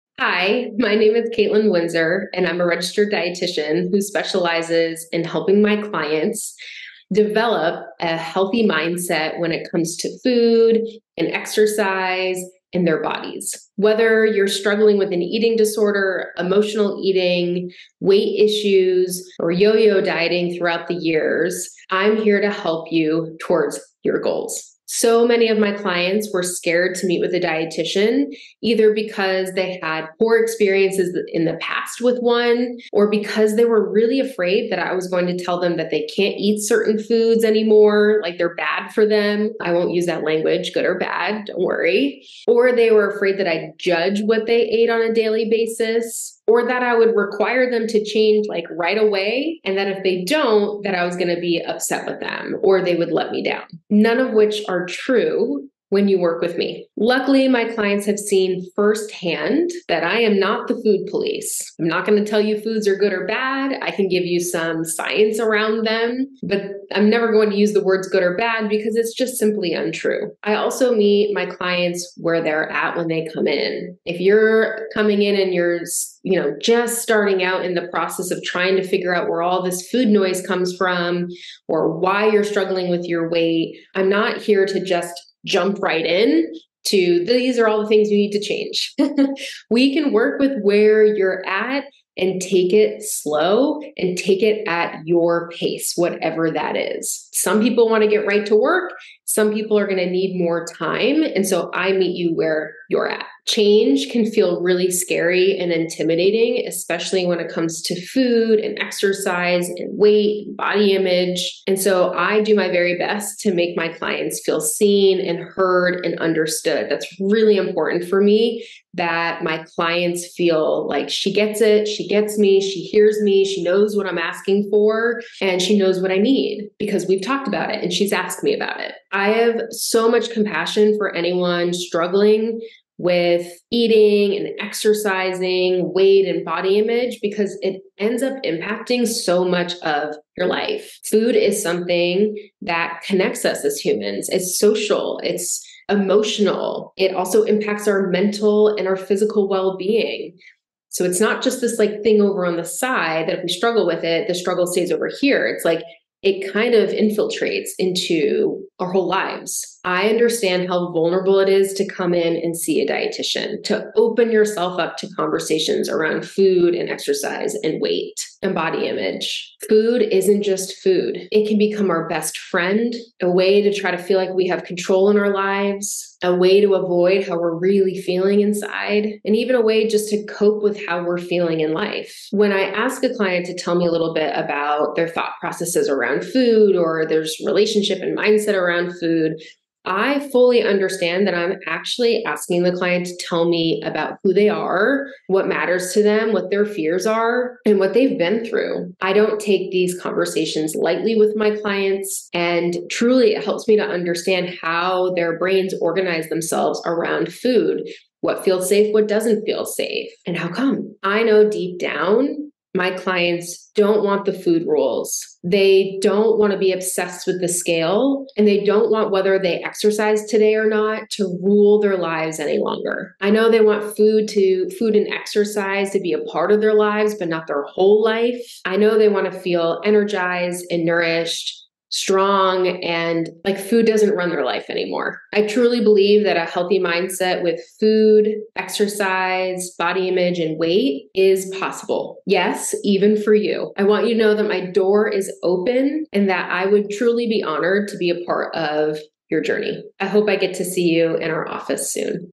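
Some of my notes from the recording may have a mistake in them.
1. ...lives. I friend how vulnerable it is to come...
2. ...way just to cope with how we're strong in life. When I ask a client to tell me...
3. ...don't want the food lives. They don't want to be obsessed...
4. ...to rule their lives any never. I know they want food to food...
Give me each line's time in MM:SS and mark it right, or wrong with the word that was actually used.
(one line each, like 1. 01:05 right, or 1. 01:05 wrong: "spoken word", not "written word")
1. 02:39 wrong: "understand", not "friend"
2. 02:59 wrong: "feeling", not "strong"
3. 03:33 wrong: "rules", not "lives"
4. 03:41 wrong: "longer", not "never".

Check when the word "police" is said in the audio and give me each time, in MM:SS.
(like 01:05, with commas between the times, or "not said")
01:01.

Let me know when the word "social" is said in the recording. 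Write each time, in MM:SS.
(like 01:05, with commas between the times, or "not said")
02:24.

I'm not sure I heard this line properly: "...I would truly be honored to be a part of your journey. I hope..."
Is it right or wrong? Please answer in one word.
right.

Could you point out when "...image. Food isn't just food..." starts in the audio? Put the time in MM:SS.
02:48.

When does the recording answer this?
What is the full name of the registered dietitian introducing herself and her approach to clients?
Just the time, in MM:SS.
00:01.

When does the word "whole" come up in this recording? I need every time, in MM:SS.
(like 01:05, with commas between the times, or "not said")
02:38, 03:47.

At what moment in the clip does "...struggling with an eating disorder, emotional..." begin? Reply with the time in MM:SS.
00:14.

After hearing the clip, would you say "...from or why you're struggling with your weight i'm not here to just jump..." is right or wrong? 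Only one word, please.
right.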